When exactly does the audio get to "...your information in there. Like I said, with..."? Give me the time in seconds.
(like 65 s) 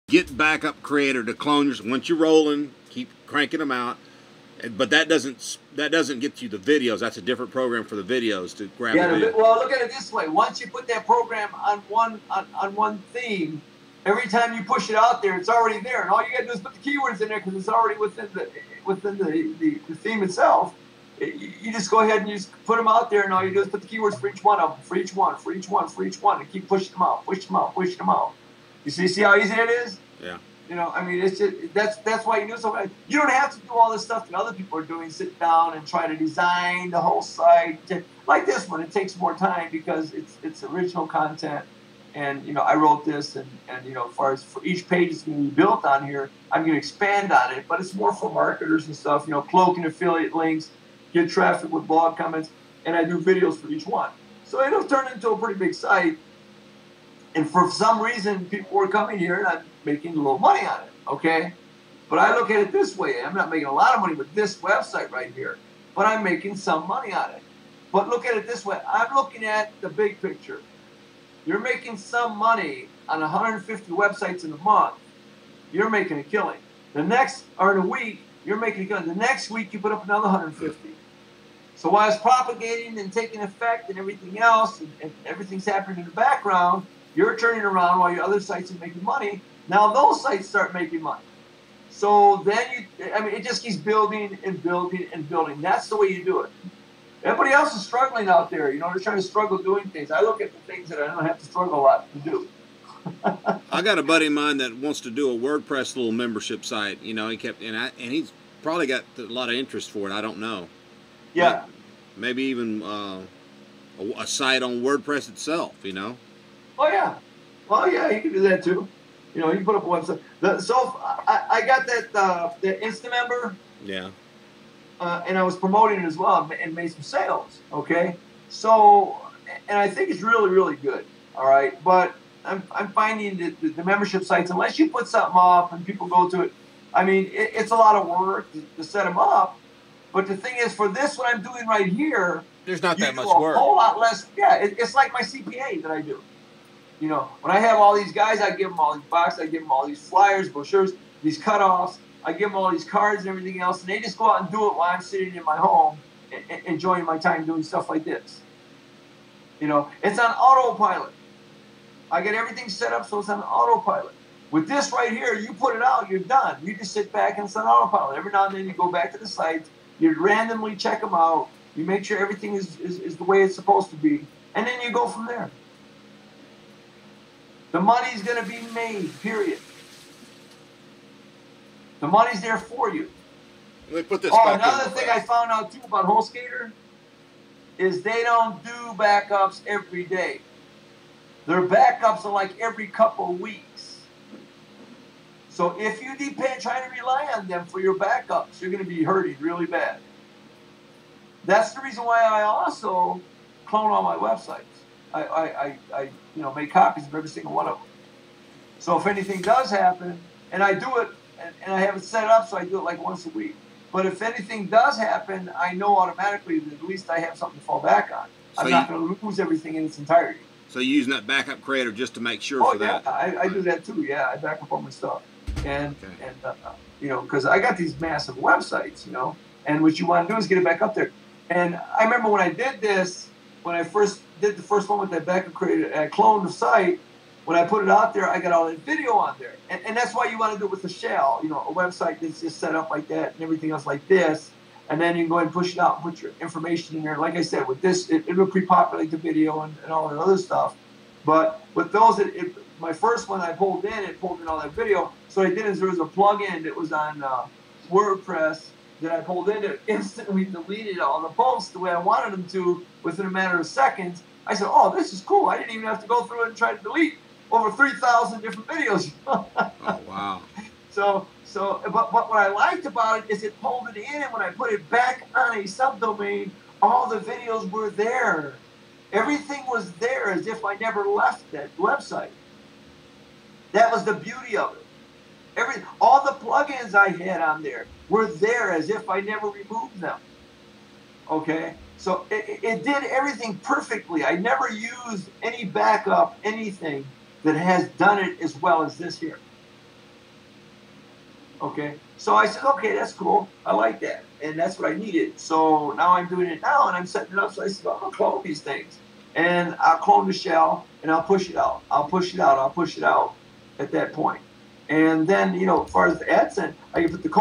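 246 s.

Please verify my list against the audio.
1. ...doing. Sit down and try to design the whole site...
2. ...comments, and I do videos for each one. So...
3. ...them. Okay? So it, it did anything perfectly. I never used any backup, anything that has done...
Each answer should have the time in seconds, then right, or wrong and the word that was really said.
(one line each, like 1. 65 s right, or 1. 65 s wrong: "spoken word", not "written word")
1. 34 s right
2. 52 s right
3. 289 s wrong: "everything", not "anything".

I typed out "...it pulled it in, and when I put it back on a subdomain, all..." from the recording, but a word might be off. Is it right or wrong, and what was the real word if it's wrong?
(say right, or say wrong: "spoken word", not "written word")
right.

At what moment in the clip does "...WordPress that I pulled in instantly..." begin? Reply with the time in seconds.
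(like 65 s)
257 s.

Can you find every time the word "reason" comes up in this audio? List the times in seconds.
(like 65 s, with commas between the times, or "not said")
58 s, 201 s.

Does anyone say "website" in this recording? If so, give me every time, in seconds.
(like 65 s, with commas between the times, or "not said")
64 s, 73 s, 119 s, 204 s, 228 s, 241 s, 281 s.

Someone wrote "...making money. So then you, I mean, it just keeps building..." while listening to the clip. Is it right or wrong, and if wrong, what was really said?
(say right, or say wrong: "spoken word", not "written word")
right.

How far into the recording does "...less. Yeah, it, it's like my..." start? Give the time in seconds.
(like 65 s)
143 s.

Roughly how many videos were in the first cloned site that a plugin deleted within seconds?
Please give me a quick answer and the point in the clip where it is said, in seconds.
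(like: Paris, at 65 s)
3,000, at 267 s.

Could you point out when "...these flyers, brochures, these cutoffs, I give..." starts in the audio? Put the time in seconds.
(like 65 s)
149 s.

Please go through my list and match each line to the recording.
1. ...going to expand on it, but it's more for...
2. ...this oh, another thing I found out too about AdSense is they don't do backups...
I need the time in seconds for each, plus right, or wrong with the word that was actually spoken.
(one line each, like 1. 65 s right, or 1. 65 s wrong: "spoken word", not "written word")
1. 46 s right
2. 184 s wrong: "HostGator", not "AdSense".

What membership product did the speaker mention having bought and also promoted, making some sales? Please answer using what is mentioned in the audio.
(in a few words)
Instamember.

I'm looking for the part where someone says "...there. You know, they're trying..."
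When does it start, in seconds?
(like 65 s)
98 s.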